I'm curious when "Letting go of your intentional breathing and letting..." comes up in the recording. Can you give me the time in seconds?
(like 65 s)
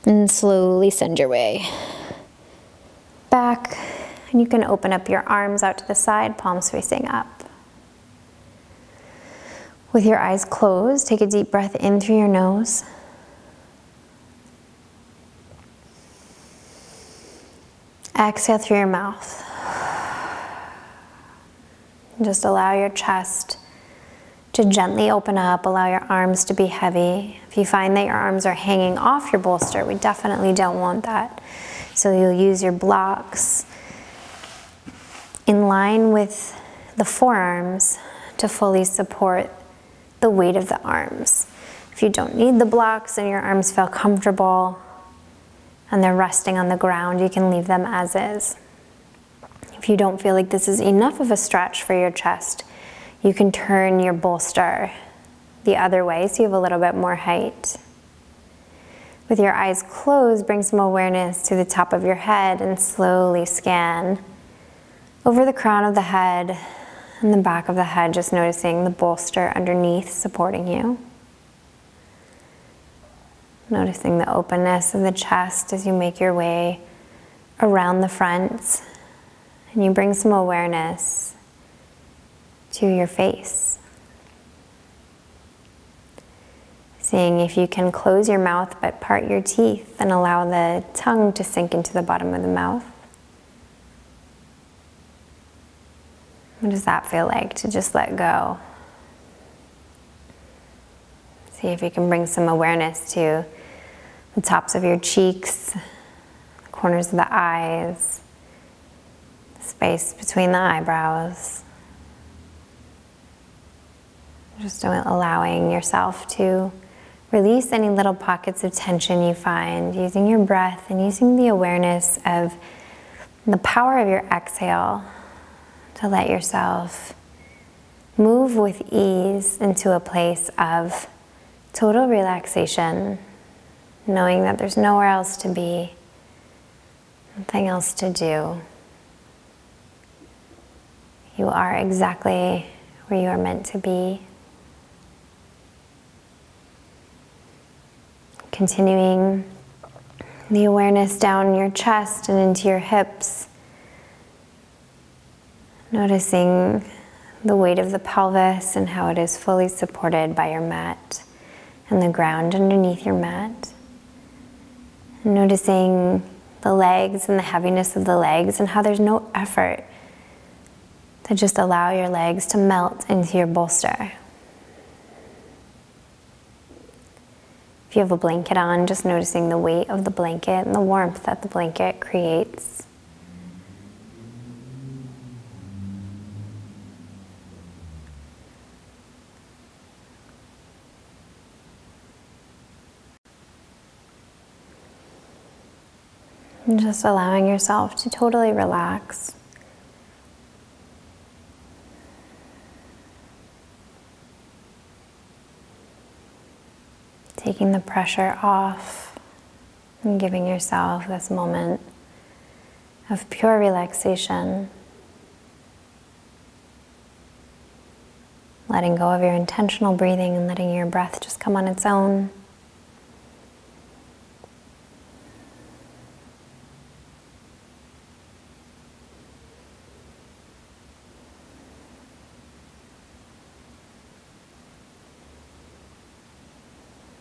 218 s.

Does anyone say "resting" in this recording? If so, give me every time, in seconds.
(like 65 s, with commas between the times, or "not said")
46 s.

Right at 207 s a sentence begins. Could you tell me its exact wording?
Taking the pressure off and giving yourself this moment of pure relaxation.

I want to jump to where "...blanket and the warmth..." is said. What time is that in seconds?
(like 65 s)
180 s.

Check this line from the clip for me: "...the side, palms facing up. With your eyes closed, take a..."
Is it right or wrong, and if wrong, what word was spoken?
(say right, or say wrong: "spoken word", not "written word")
right.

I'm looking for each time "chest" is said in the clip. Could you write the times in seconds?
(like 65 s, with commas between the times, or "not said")
22 s, 52 s, 75 s, 151 s.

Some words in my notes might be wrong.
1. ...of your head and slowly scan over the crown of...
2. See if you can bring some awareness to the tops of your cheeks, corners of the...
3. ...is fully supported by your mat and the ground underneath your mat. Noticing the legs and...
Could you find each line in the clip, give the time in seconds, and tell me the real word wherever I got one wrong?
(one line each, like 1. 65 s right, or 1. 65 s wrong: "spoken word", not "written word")
1. 61 s right
2. 101 s right
3. 159 s right.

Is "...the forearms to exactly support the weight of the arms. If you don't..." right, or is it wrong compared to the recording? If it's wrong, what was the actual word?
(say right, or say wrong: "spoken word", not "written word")
wrong: "fully", not "exactly".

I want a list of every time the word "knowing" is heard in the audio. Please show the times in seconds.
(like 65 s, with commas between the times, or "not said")
134 s.